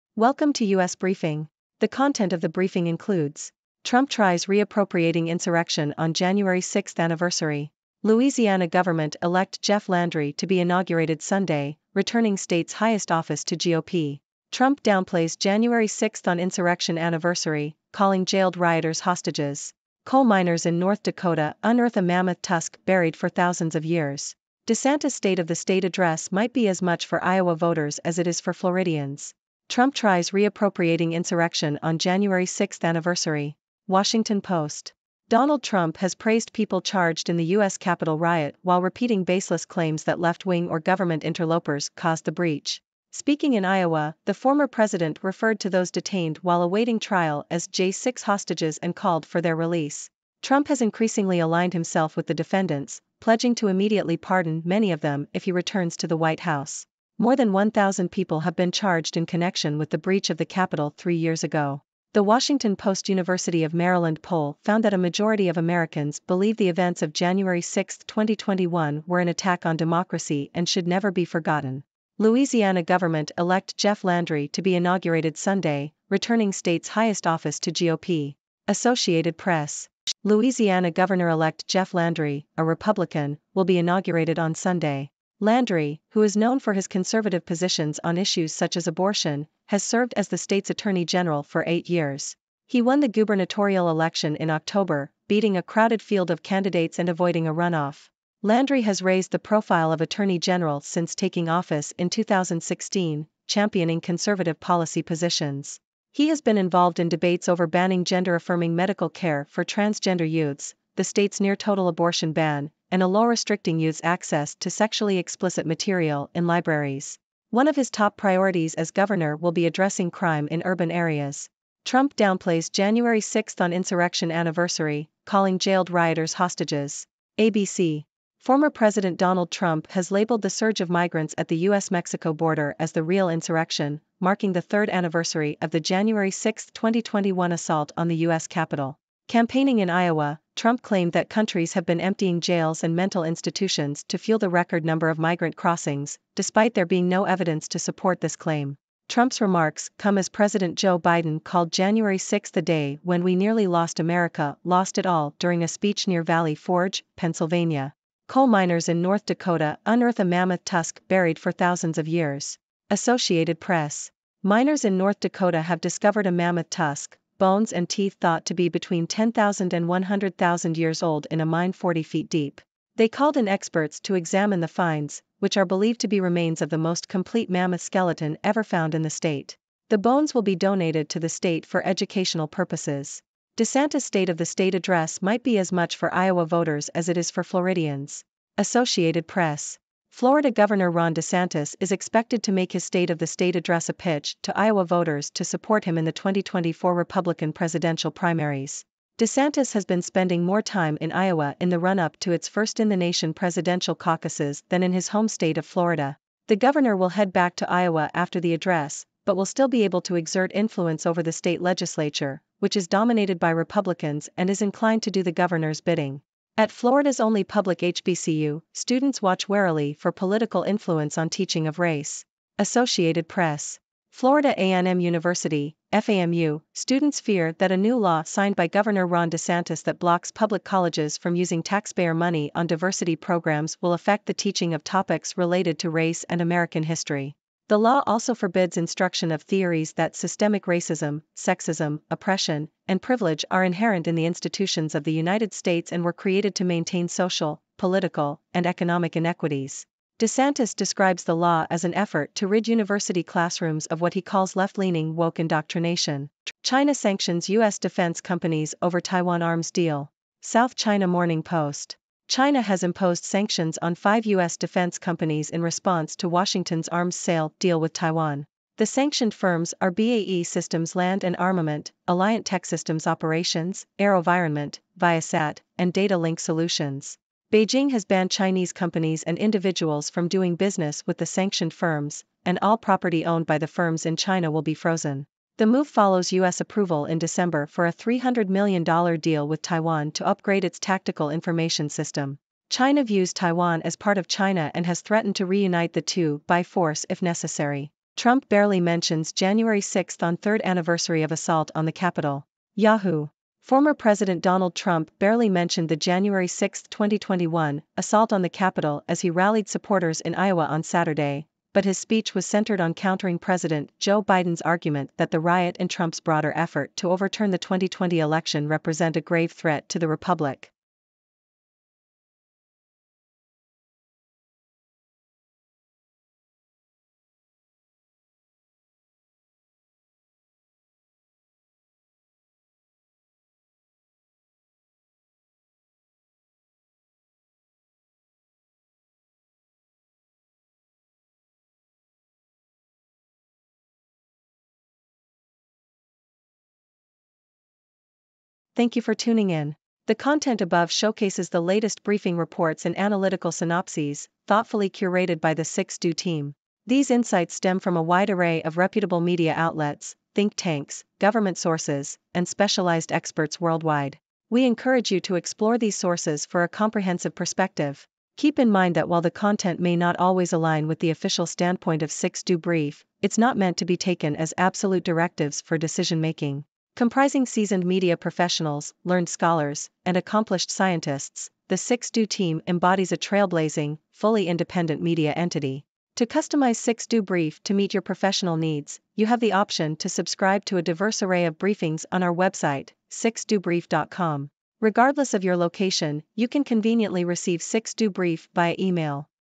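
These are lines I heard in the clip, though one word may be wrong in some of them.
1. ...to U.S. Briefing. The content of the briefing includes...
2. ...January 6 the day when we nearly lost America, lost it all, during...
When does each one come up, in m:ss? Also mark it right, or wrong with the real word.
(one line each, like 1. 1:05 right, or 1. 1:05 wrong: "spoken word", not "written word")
1. 0:00 right
2. 2:31 right.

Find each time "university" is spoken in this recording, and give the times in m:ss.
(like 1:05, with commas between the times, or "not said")
1:03, 3:44, 4:12.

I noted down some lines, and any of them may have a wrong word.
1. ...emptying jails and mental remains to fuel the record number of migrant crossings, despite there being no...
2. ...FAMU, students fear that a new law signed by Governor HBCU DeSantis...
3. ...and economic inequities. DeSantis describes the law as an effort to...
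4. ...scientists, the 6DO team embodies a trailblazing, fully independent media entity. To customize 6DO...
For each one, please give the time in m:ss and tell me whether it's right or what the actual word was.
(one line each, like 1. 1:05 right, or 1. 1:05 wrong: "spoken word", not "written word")
1. 2:22 wrong: "institutions", not "remains"
2. 3:45 wrong: "Ron", not "HBCU"
3. 4:08 right
4. 6:20 right.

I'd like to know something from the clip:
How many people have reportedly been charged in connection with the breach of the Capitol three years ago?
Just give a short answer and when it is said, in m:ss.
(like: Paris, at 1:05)
More than 1,000, at 0:57.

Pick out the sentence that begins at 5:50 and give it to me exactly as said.
The content above showcases the latest briefing reports and analytical synopses, thoughtfully curated by the 6DO team.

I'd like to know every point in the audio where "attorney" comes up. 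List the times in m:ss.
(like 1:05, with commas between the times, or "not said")
1:30, 1:39.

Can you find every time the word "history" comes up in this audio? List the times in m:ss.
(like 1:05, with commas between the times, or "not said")
3:56.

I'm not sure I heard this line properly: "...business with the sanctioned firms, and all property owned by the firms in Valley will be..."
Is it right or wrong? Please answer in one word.
wrong.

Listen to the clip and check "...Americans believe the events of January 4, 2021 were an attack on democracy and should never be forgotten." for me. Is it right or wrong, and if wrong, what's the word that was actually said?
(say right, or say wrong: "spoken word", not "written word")
wrong: "6", not "4".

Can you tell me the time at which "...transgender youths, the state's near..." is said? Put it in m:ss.
1:49.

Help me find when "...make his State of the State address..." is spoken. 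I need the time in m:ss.
3:12.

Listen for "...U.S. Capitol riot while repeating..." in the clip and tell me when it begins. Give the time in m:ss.
0:37.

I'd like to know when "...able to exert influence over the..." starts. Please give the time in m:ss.
3:29.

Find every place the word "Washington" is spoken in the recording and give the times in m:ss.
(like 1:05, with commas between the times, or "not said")
0:33, 1:02, 4:26.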